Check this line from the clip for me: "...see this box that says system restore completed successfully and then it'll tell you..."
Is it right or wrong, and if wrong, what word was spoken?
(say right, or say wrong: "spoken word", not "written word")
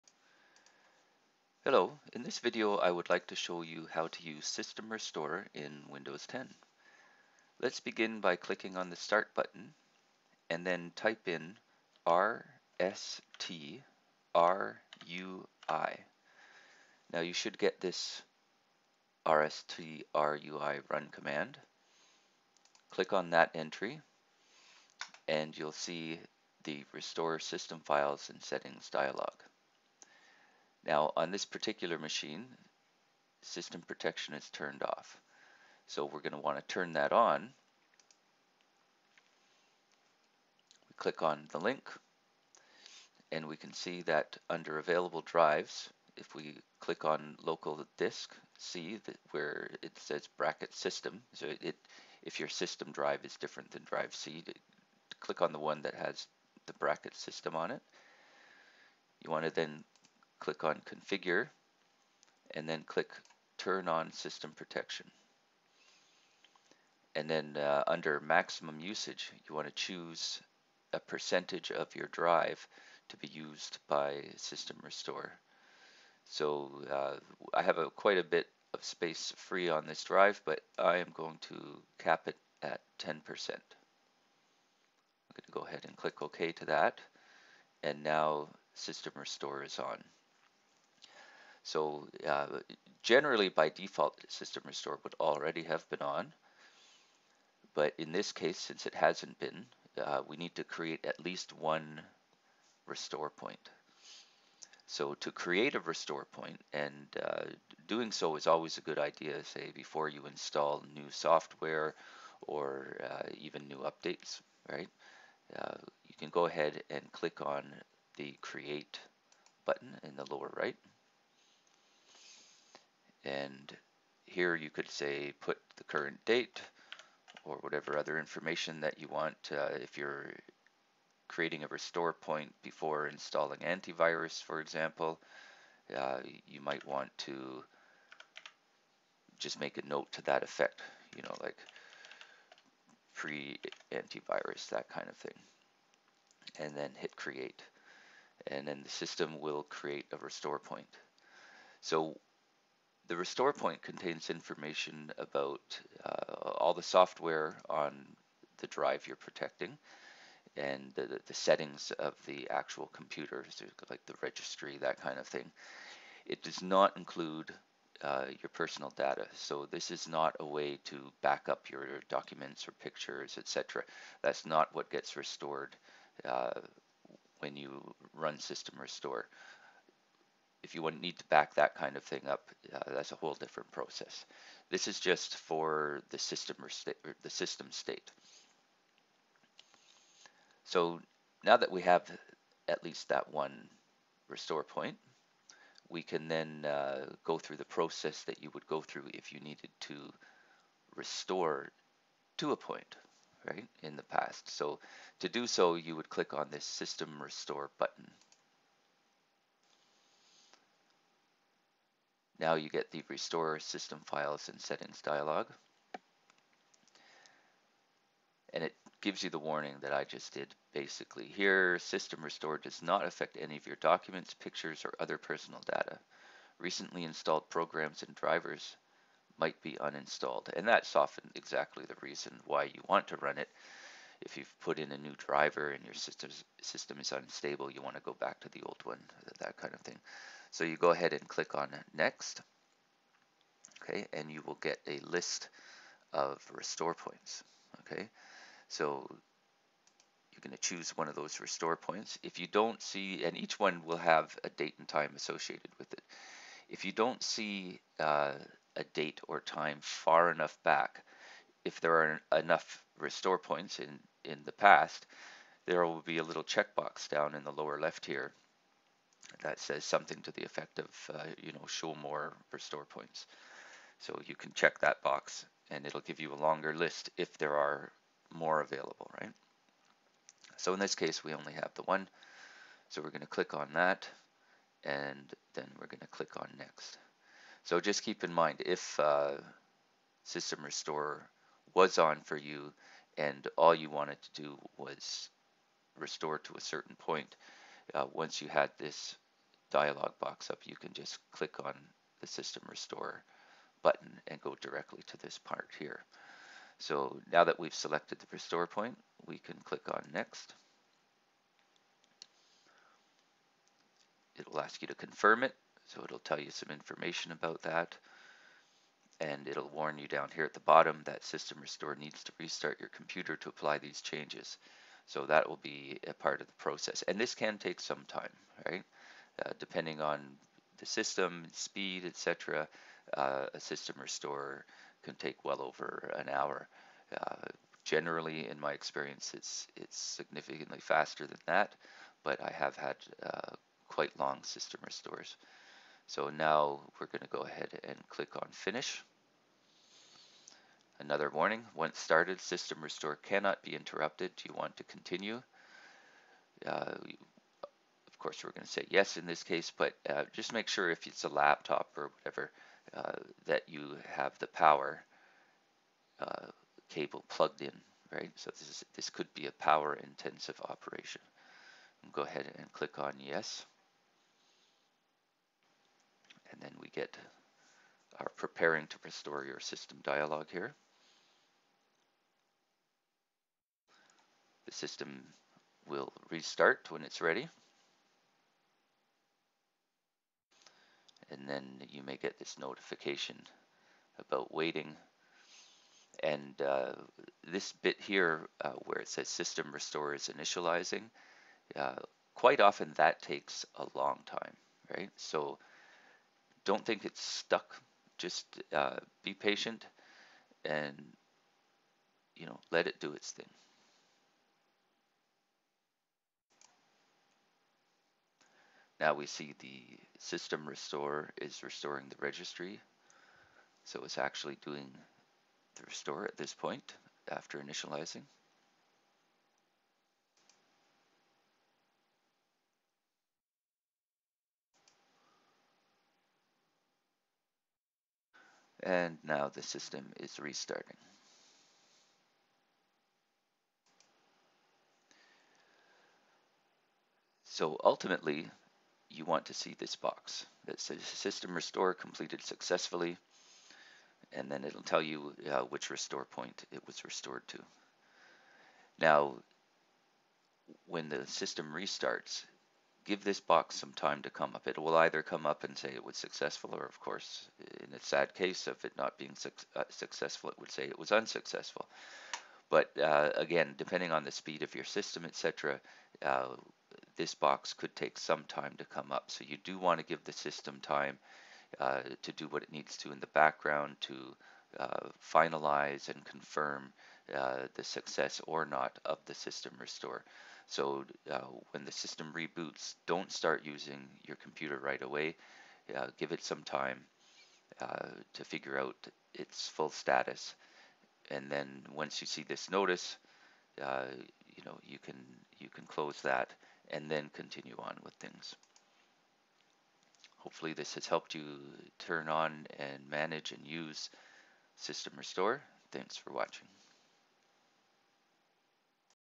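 right.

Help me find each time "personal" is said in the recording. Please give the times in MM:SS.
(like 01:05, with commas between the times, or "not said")
02:48, 03:45.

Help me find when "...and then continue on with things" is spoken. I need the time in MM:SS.
08:26.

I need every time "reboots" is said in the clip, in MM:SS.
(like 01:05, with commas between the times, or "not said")
08:12.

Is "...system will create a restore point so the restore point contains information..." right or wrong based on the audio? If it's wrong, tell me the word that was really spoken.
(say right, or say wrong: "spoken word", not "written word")
right.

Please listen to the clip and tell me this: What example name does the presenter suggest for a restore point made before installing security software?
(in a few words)
pre antivirus.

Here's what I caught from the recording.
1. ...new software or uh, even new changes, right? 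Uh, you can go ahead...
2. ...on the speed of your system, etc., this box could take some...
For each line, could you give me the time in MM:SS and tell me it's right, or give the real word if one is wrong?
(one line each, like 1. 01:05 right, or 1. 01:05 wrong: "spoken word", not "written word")
1. 01:50 wrong: "updates", not "changes"
2. 07:54 right.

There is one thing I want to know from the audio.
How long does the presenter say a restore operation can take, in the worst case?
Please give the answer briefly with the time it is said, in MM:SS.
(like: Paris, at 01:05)
well over an hour, at 05:35.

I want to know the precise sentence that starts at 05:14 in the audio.
It'll ask you to confirm it.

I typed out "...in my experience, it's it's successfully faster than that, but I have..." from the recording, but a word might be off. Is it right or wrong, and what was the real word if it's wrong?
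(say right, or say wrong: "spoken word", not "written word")
wrong: "significantly", not "successfully".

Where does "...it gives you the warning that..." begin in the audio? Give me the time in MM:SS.
03:38.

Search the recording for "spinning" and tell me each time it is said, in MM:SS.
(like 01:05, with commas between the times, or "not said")
not said.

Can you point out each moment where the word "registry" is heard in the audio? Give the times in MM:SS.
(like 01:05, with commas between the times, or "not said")
02:44, 07:02.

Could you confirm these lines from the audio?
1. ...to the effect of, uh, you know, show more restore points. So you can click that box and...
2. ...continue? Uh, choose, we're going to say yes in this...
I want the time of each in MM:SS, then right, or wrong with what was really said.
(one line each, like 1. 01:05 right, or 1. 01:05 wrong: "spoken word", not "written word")
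1. 04:30 wrong: "check", not "click"
2. 05:54 wrong: "course", not "choose".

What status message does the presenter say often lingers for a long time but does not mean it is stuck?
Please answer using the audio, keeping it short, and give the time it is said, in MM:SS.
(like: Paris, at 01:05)
system restore is initializing, at 06:39.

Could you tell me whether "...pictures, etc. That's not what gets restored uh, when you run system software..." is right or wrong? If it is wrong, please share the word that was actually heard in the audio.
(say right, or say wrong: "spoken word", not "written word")
wrong: "restore", not "software".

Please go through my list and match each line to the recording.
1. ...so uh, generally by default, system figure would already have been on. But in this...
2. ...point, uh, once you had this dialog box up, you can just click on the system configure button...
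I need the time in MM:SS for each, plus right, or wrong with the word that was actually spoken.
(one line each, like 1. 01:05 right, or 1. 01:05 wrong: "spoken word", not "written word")
1. 01:31 wrong: "restore", not "figure"
2. 04:56 wrong: "restore", not "configure".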